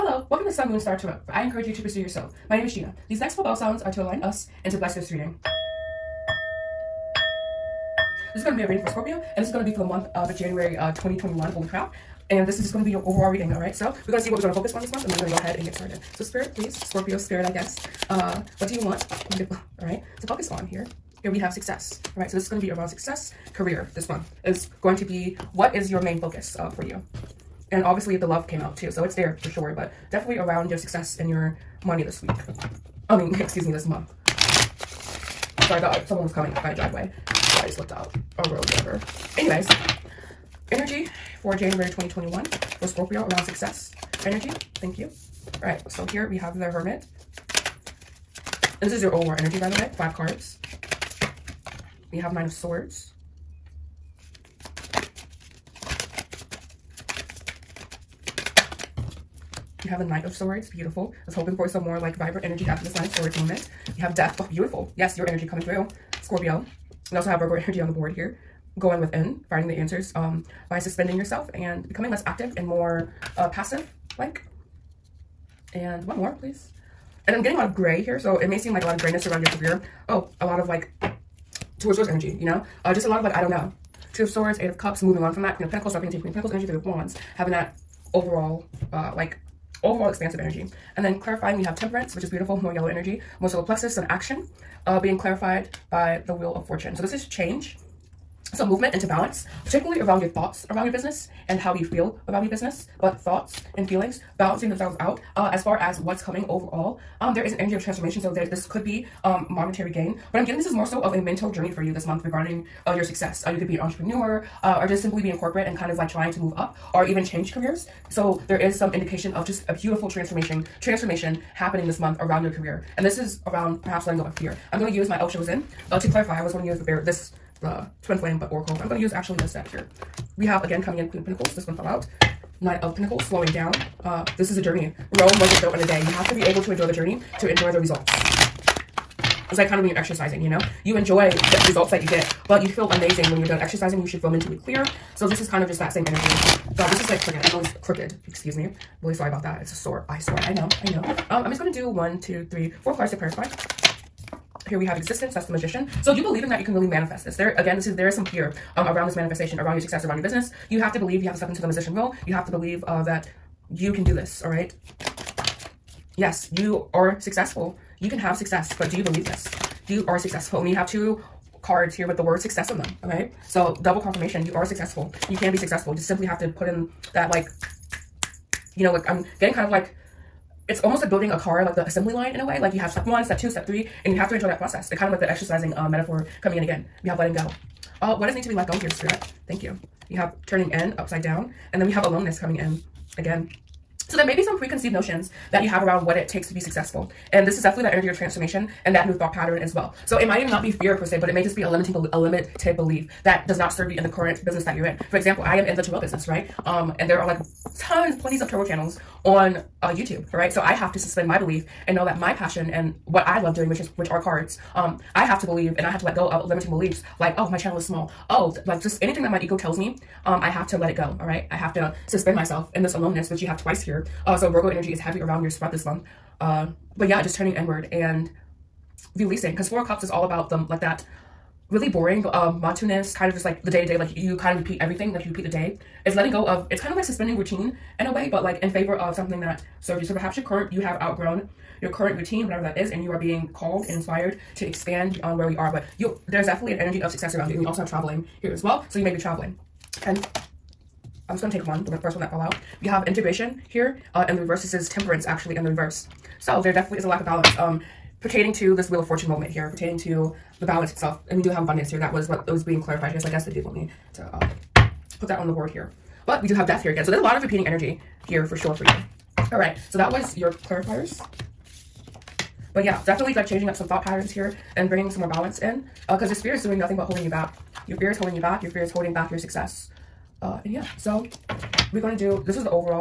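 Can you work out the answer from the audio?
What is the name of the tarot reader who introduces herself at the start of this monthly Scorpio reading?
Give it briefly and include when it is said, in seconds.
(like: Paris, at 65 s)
Gina, at 2 s.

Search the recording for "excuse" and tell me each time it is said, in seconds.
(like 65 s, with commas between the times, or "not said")
33 s, 148 s.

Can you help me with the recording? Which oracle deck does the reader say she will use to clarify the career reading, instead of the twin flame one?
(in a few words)
Osho Zen.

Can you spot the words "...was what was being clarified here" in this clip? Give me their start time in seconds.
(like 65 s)
262 s.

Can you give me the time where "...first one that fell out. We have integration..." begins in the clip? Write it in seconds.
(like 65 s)
252 s.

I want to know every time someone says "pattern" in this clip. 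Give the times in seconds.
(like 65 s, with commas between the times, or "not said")
199 s, 274 s.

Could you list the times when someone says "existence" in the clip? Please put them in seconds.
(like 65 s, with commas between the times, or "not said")
154 s.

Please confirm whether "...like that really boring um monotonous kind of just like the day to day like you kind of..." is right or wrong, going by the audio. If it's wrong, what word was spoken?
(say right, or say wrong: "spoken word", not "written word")
right.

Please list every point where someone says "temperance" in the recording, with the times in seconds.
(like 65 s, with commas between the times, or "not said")
91 s, 254 s.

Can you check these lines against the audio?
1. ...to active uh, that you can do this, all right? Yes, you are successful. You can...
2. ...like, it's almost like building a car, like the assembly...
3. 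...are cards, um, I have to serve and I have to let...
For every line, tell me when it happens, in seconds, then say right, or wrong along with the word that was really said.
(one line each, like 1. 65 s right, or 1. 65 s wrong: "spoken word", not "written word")
1. 162 s wrong: "believe", not "active"
2. 179 s right
3. 214 s wrong: "believe", not "serve".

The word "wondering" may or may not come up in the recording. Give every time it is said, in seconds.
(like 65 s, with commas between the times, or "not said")
not said.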